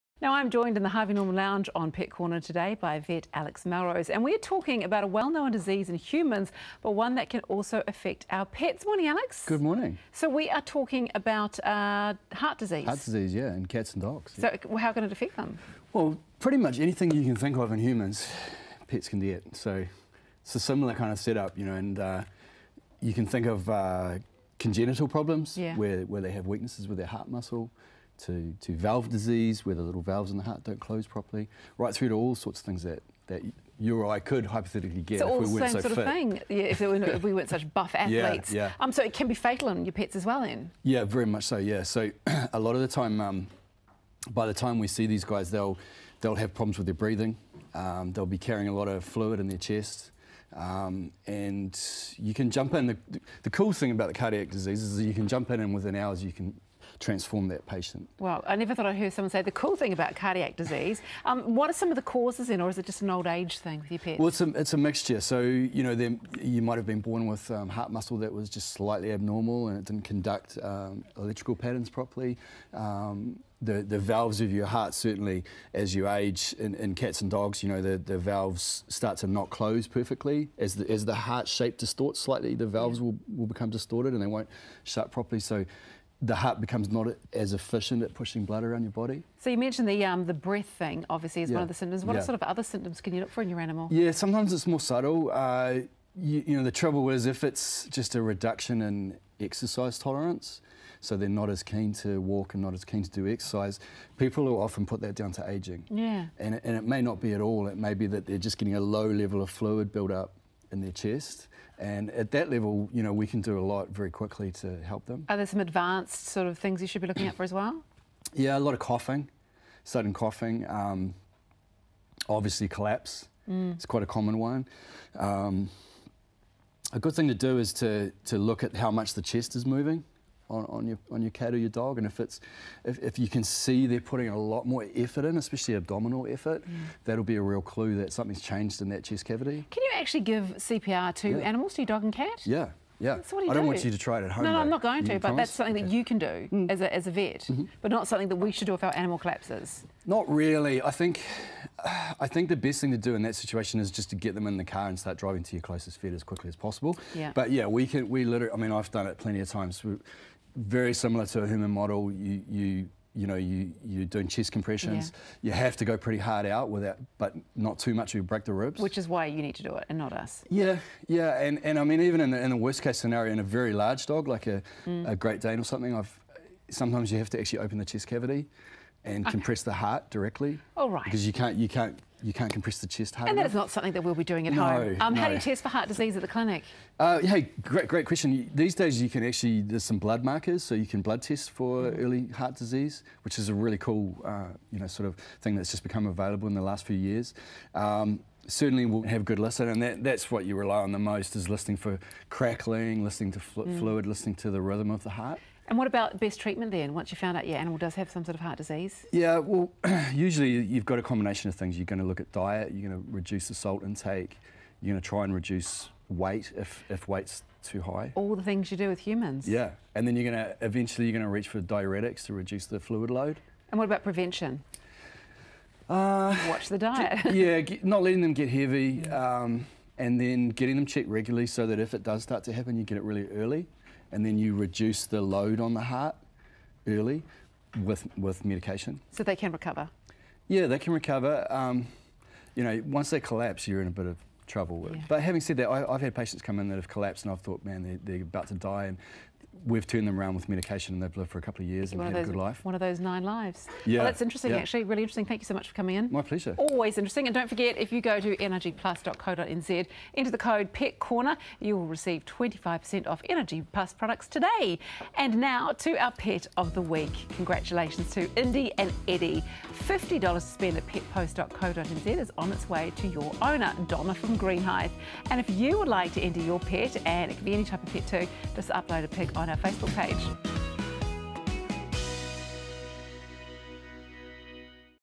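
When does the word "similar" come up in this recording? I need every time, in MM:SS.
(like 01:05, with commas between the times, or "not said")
00:20, 02:40.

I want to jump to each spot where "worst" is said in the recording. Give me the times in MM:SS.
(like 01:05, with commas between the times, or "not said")
02:52.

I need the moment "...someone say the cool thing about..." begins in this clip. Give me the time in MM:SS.
00:59.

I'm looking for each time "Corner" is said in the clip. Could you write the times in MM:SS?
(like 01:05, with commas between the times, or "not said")
00:02, 04:20.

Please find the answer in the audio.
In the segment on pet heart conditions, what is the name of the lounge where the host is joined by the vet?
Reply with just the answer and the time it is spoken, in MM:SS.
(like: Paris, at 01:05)
Harvey Norman Lounge, at 00:00.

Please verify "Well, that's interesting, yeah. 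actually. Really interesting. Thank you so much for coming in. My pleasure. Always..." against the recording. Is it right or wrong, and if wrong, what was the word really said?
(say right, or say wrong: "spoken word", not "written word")
right.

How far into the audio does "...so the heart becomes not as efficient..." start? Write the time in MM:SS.
01:25.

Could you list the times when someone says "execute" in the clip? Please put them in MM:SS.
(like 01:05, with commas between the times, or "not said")
not said.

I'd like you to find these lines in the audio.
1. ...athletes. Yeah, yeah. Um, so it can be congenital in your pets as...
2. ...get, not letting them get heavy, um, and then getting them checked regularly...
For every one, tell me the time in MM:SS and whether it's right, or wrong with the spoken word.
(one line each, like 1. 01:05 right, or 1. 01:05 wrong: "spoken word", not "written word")
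1. 00:37 wrong: "fatal", not "congenital"
2. 03:47 right.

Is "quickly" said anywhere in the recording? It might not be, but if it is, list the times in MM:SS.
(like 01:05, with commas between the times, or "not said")
01:54, 02:36.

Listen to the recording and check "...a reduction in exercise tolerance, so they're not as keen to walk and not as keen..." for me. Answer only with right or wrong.
right.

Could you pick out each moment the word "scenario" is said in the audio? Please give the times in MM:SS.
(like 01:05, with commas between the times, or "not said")
02:52.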